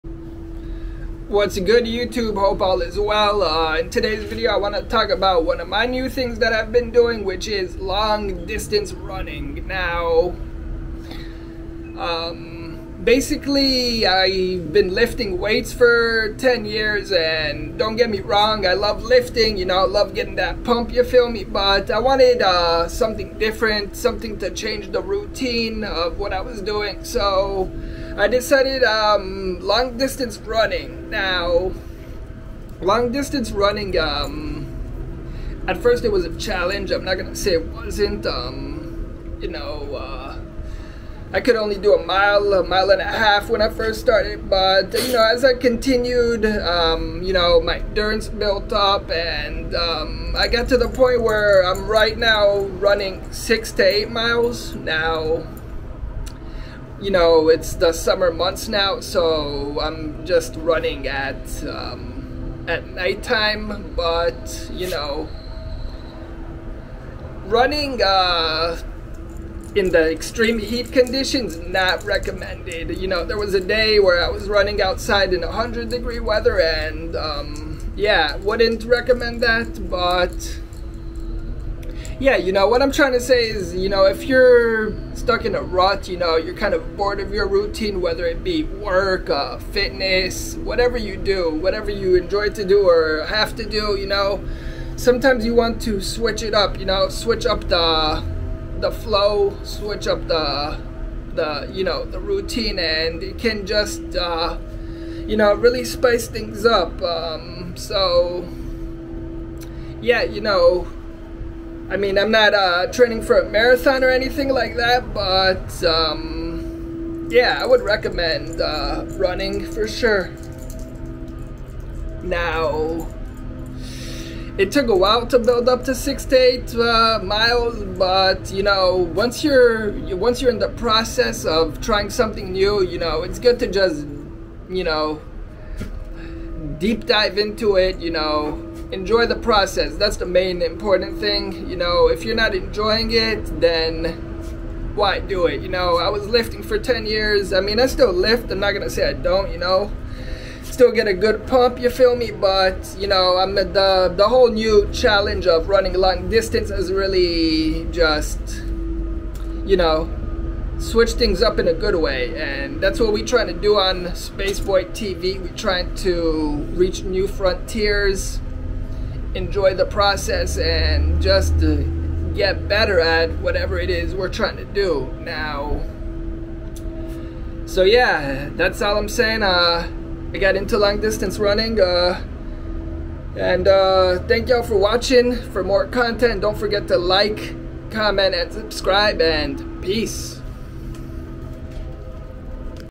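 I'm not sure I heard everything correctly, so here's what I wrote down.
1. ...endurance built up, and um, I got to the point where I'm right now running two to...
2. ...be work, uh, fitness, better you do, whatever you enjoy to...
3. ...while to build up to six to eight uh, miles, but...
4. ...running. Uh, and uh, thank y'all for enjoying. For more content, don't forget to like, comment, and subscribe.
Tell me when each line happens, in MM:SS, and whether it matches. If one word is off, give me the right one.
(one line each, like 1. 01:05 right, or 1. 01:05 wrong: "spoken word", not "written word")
1. 00:47 wrong: "six", not "two"
2. 01:28 wrong: "whatever", not "better"
3. 02:04 right
4. 03:01 wrong: "watching", not "enjoying".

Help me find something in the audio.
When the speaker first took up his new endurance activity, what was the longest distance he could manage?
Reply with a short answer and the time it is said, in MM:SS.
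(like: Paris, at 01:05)
a mile and a half, at 00:42.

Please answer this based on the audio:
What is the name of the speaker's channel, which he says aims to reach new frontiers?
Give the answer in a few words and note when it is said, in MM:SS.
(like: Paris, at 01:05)
Spaceboy TV, at 02:44.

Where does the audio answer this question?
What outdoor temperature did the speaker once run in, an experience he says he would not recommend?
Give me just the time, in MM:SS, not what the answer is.
01:15.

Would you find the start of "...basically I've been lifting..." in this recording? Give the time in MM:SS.
00:13.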